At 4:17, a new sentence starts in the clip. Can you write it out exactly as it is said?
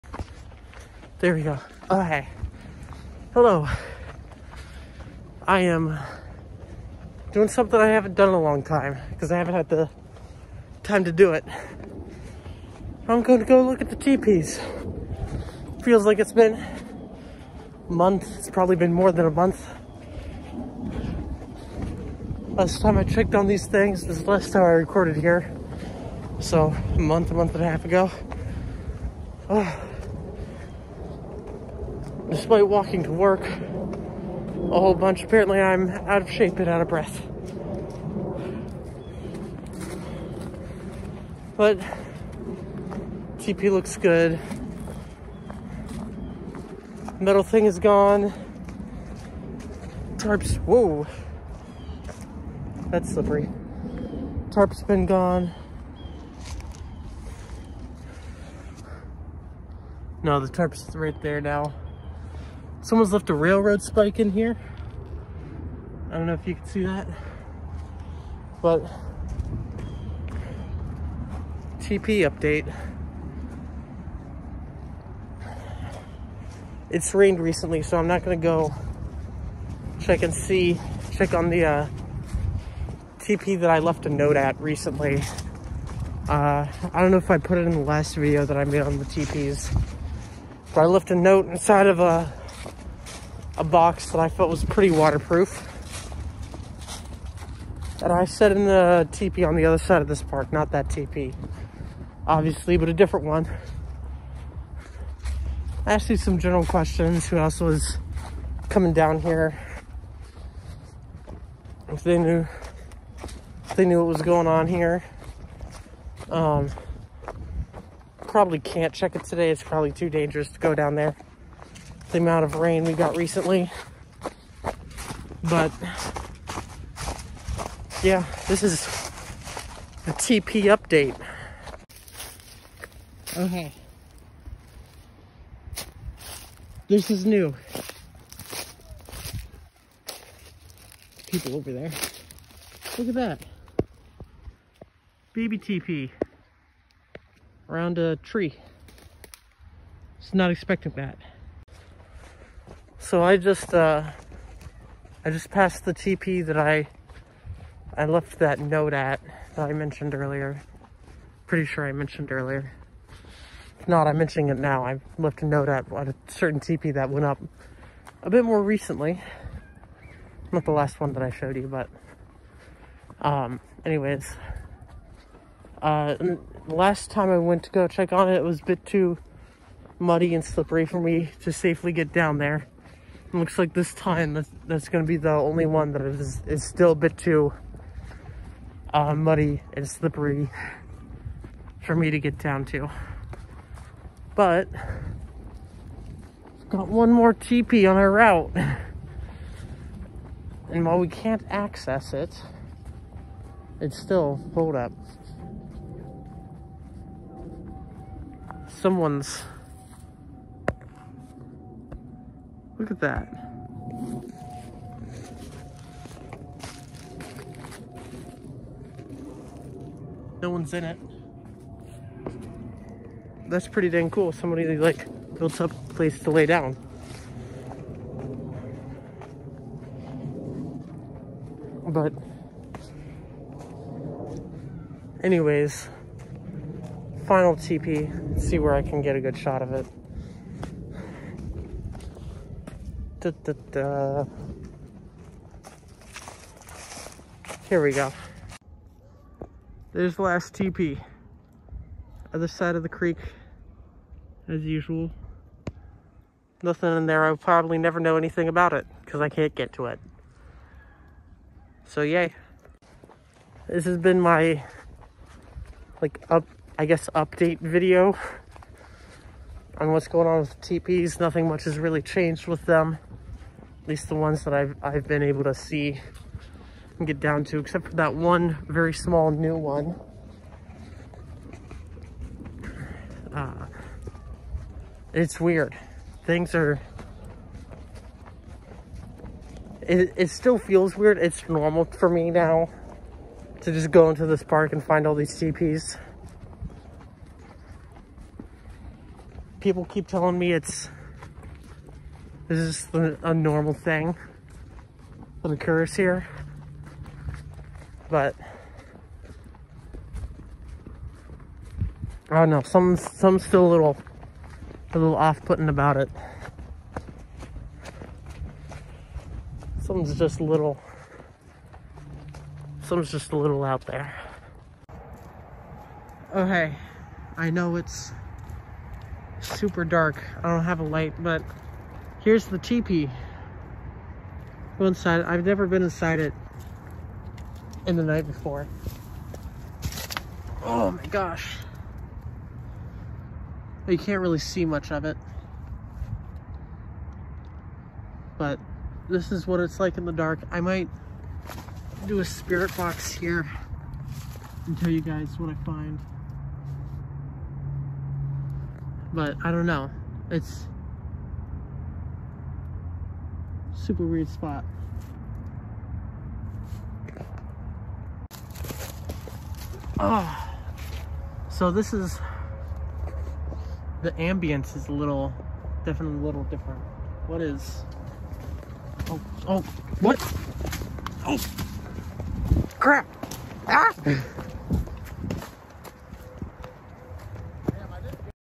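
I'll probably never know anything about it because I can't get to it.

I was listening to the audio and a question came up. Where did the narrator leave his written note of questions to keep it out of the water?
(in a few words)
a box.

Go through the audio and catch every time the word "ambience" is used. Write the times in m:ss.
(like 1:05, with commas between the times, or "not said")
6:14.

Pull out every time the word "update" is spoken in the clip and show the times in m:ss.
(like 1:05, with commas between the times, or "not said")
1:12, 2:10, 4:27.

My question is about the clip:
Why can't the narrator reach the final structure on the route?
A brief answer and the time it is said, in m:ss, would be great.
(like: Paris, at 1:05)
other side of the creek, at 4:12.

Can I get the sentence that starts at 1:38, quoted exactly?
And I set in the teepee on the other side of this park, not that teepee, obviously, but a different one.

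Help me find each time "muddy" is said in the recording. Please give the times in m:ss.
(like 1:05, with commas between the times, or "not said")
2:59, 3:09.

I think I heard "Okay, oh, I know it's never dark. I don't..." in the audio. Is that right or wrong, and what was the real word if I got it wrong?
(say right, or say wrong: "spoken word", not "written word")
wrong: "super", not "never".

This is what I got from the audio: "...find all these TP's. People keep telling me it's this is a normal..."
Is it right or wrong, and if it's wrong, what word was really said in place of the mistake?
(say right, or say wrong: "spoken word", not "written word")
right.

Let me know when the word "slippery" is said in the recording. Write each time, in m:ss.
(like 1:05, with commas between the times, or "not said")
0:53, 3:00, 3:09.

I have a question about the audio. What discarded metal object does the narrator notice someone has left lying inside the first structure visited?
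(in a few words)
railroad spike.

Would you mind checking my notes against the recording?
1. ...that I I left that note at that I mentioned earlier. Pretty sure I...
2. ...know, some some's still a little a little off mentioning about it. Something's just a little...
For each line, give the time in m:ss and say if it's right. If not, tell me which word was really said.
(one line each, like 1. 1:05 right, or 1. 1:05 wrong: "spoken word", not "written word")
1. 2:36 right
2. 5:12 wrong: "putting", not "mentioning".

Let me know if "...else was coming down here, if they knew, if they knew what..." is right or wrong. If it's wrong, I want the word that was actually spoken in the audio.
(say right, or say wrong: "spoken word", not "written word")
right.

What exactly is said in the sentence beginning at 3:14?
But got one more teepee on our route.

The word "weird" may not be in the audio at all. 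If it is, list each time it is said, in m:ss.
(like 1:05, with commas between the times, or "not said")
4:45, 4:50, 6:04.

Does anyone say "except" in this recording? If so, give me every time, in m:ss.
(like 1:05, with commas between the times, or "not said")
4:37.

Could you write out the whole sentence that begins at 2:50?
Not the last one that I showed you, but um, anyways.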